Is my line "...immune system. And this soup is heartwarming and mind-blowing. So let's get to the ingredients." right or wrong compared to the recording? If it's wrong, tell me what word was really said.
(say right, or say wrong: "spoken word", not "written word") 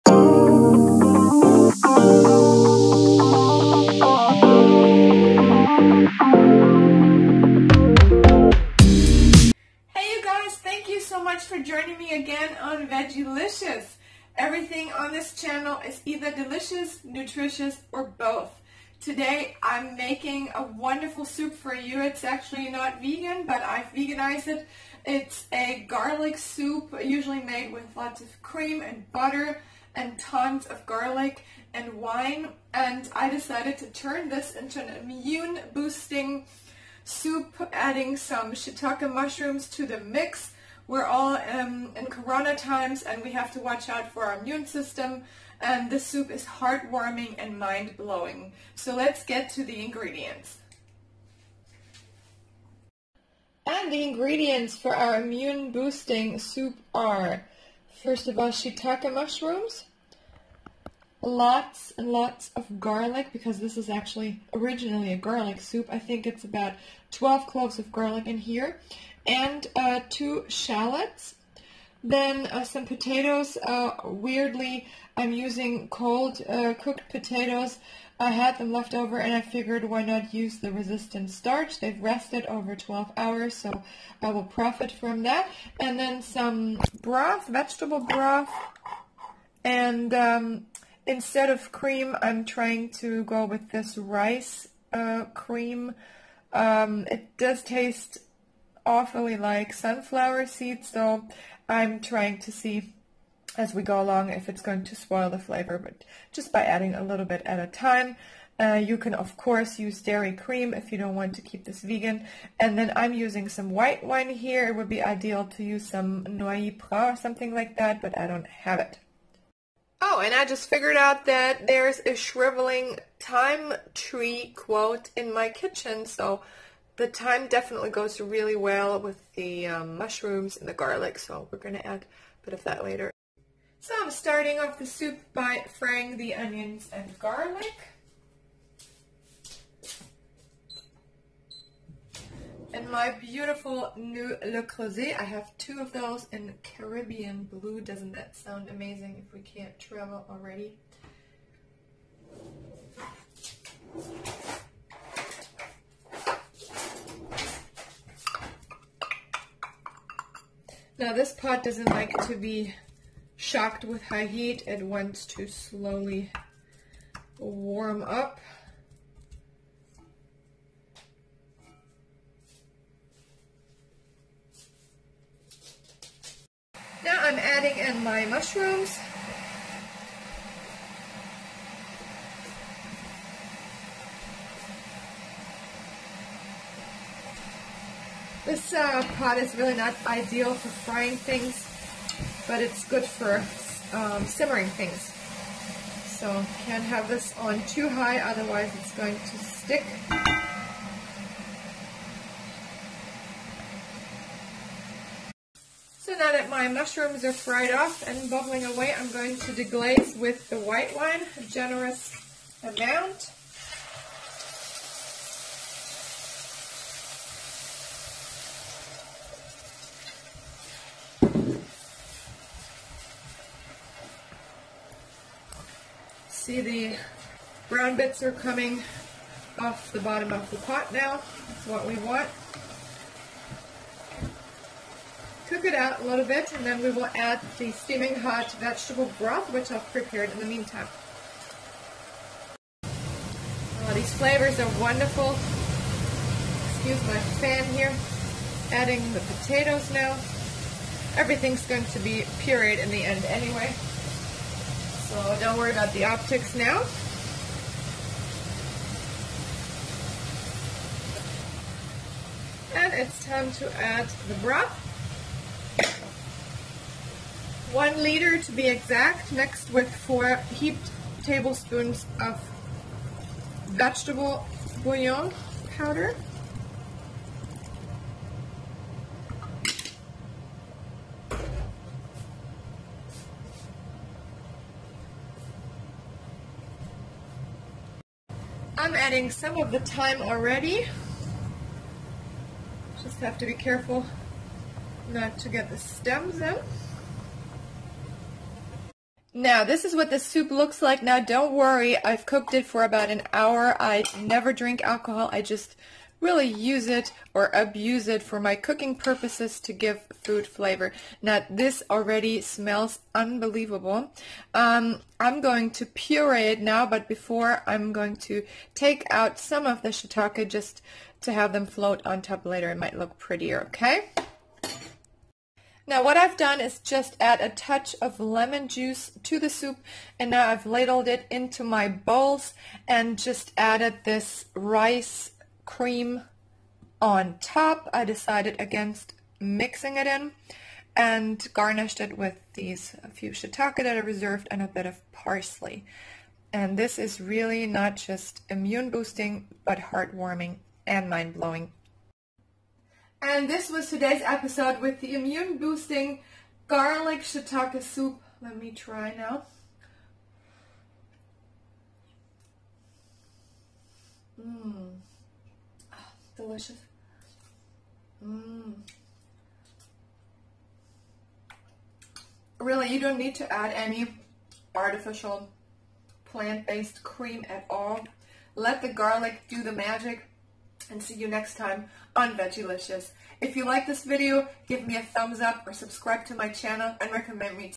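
right.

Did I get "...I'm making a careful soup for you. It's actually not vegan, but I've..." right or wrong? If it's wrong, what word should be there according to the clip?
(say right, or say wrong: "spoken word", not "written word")
wrong: "wonderful", not "careful".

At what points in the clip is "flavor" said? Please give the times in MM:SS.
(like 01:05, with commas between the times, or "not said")
01:45, 04:04, 05:10.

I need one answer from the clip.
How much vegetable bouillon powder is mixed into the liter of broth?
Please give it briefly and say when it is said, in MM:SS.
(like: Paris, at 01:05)
4 heaped tablespoons, at 04:29.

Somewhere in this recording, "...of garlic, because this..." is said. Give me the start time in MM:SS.
01:02.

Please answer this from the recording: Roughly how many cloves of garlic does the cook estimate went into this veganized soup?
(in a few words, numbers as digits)
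12.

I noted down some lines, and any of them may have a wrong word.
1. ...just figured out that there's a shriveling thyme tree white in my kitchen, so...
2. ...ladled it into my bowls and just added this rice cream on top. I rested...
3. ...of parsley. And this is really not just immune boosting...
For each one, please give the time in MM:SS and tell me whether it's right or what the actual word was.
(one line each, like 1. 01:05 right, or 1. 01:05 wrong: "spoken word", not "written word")
1. 02:00 wrong: "quote", not "white"
2. 05:30 wrong: "decided", not "rested"
3. 05:44 right.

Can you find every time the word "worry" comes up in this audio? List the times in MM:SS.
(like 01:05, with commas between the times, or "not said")
04:15, 05:01.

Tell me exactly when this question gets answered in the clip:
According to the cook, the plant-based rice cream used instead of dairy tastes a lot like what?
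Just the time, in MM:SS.
01:39.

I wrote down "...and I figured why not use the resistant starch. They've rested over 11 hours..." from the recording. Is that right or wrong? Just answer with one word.
wrong.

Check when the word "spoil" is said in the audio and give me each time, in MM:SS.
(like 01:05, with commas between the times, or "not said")
01:44.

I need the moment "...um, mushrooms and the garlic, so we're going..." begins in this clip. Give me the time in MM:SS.
02:09.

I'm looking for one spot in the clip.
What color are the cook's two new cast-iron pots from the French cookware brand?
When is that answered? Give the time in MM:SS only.
02:26.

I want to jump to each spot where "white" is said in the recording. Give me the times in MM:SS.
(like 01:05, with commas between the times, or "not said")
01:53, 03:30.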